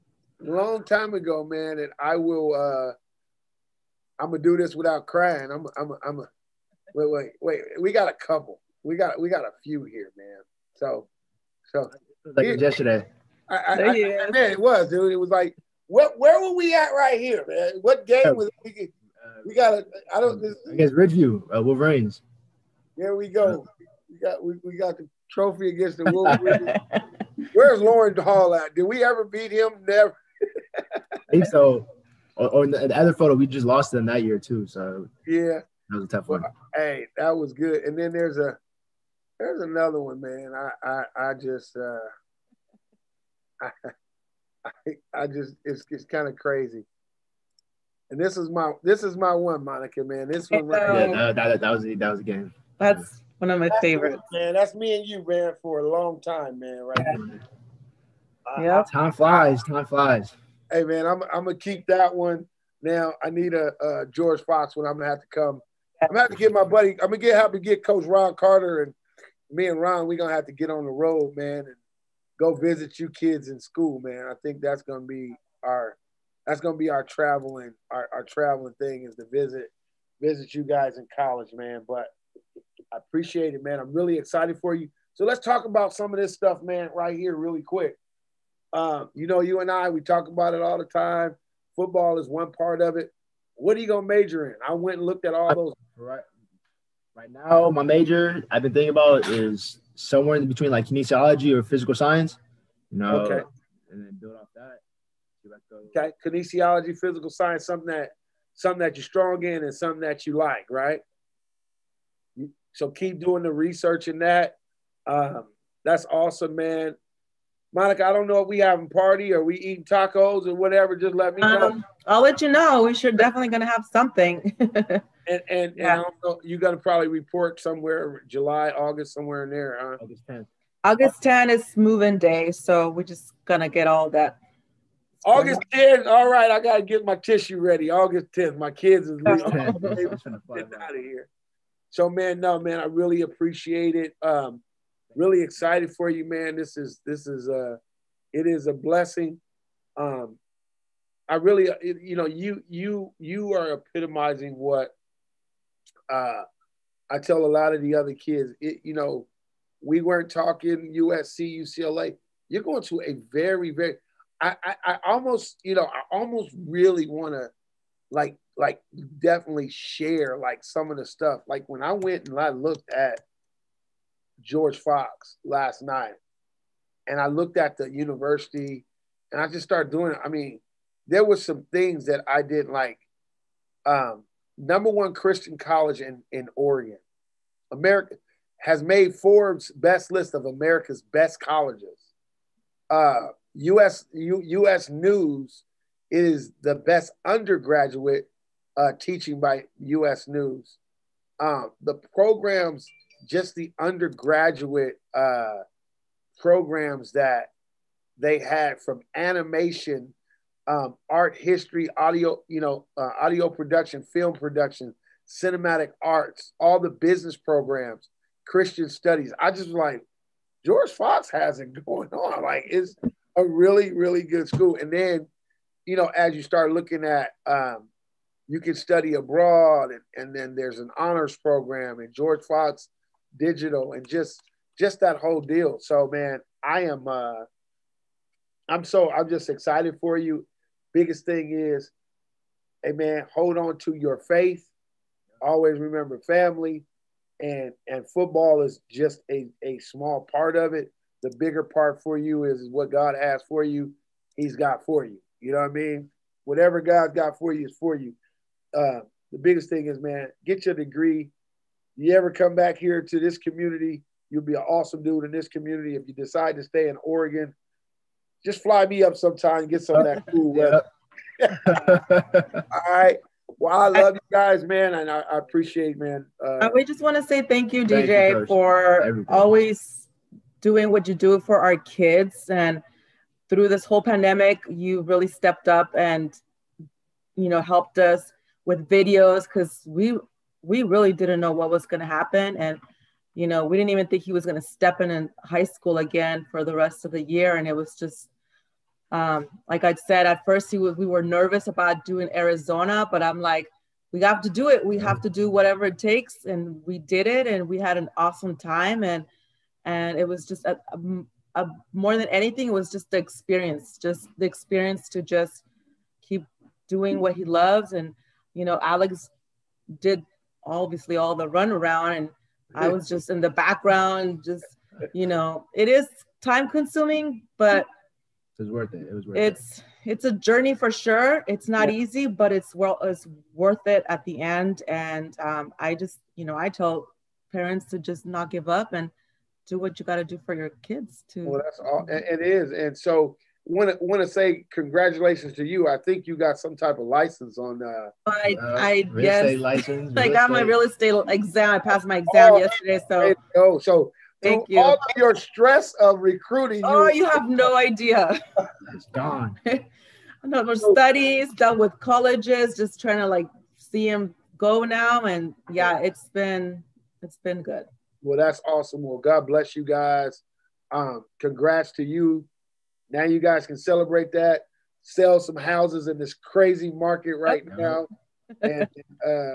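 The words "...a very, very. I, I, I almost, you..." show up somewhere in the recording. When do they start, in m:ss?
2:43.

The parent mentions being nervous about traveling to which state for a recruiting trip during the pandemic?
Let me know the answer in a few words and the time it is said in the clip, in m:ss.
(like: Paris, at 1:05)
Arizona, at 5:02.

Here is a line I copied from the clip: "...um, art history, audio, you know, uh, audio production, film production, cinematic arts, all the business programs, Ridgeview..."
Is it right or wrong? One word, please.
wrong.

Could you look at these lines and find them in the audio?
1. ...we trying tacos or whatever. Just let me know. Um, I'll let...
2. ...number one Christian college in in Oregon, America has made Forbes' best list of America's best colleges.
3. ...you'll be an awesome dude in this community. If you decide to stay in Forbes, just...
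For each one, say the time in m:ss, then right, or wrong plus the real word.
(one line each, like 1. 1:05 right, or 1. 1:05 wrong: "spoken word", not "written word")
1. 1:59 wrong: "eating", not "trying"
2. 3:04 right
3. 4:24 wrong: "Oregon", not "Forbes".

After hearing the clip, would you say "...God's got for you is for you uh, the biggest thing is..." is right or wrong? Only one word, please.
right.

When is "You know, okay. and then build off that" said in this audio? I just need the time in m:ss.
1:42.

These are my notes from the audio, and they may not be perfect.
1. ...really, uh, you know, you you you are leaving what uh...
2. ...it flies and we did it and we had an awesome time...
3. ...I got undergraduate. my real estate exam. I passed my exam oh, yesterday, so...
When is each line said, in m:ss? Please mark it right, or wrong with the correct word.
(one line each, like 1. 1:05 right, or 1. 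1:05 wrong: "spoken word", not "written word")
1. 2:31 wrong: "epitomizing", not "leaving"
2. 5:05 wrong: "takes", not "flies"
3. 5:50 wrong: "estate", not "undergraduate".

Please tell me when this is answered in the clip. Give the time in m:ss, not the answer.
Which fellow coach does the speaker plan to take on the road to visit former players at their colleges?
1:07.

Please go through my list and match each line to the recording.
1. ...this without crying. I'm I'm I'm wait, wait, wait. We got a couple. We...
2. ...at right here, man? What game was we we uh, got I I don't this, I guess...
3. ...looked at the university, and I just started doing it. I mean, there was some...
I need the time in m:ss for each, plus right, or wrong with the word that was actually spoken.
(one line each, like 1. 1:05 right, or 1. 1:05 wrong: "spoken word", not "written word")
1. 0:04 right
2. 0:16 right
3. 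2:57 right.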